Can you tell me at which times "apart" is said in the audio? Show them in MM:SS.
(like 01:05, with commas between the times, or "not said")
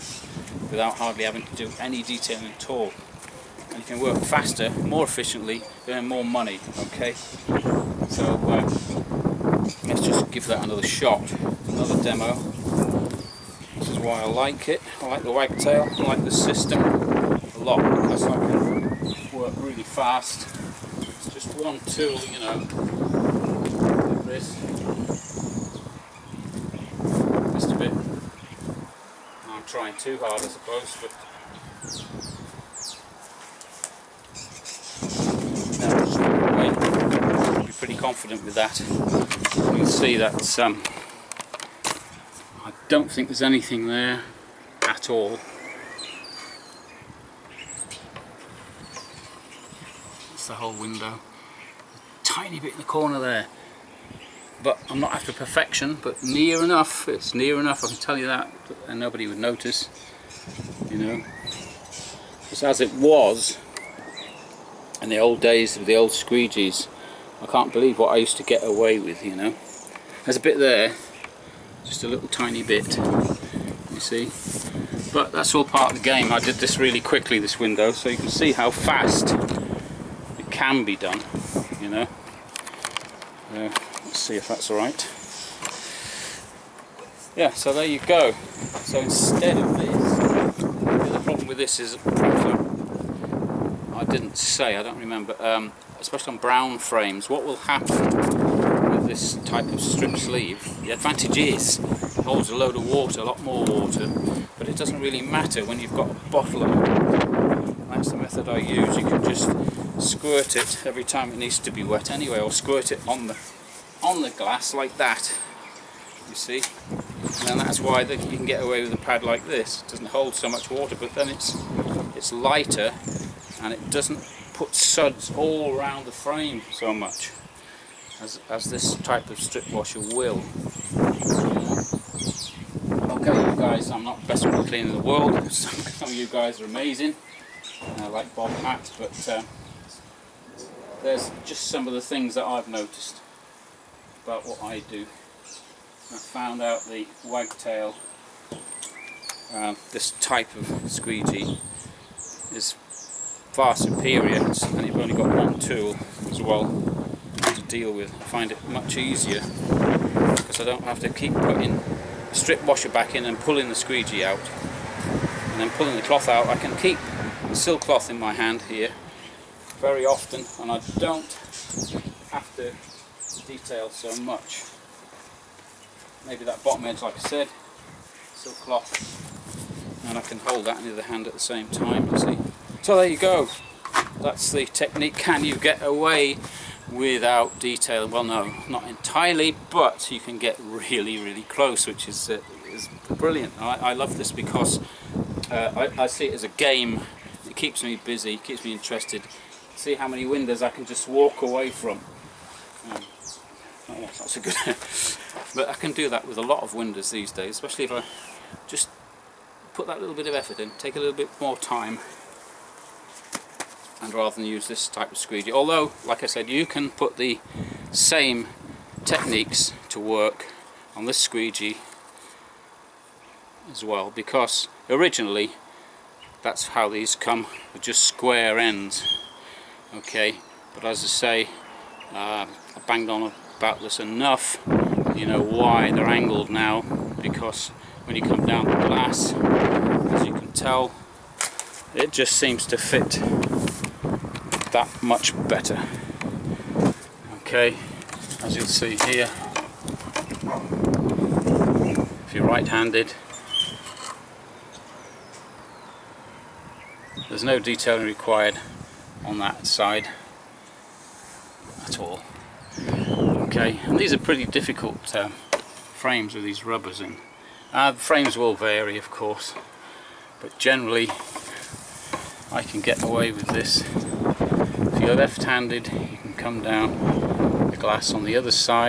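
not said.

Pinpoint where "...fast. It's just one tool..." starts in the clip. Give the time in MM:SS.
00:19.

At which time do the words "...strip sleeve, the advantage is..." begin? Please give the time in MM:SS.
01:39.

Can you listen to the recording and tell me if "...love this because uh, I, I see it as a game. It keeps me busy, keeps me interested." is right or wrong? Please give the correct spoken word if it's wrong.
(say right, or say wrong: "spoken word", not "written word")
right.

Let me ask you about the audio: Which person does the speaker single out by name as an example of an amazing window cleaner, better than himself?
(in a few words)
Bob Hat.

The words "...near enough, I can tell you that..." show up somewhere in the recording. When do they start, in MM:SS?
00:57.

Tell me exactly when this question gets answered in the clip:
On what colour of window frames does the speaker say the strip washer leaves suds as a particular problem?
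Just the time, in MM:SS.
01:36.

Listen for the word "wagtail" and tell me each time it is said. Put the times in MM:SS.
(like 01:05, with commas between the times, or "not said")
00:15, 02:27.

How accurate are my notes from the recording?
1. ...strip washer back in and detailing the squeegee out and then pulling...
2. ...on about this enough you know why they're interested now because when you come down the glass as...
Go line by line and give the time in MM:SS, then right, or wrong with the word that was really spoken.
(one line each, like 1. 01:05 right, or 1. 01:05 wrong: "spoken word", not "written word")
1. 02:42 wrong: "pulling", not "detailing"
2. 03:53 wrong: "angled", not "interested".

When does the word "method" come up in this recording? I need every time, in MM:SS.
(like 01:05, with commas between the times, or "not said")
01:48.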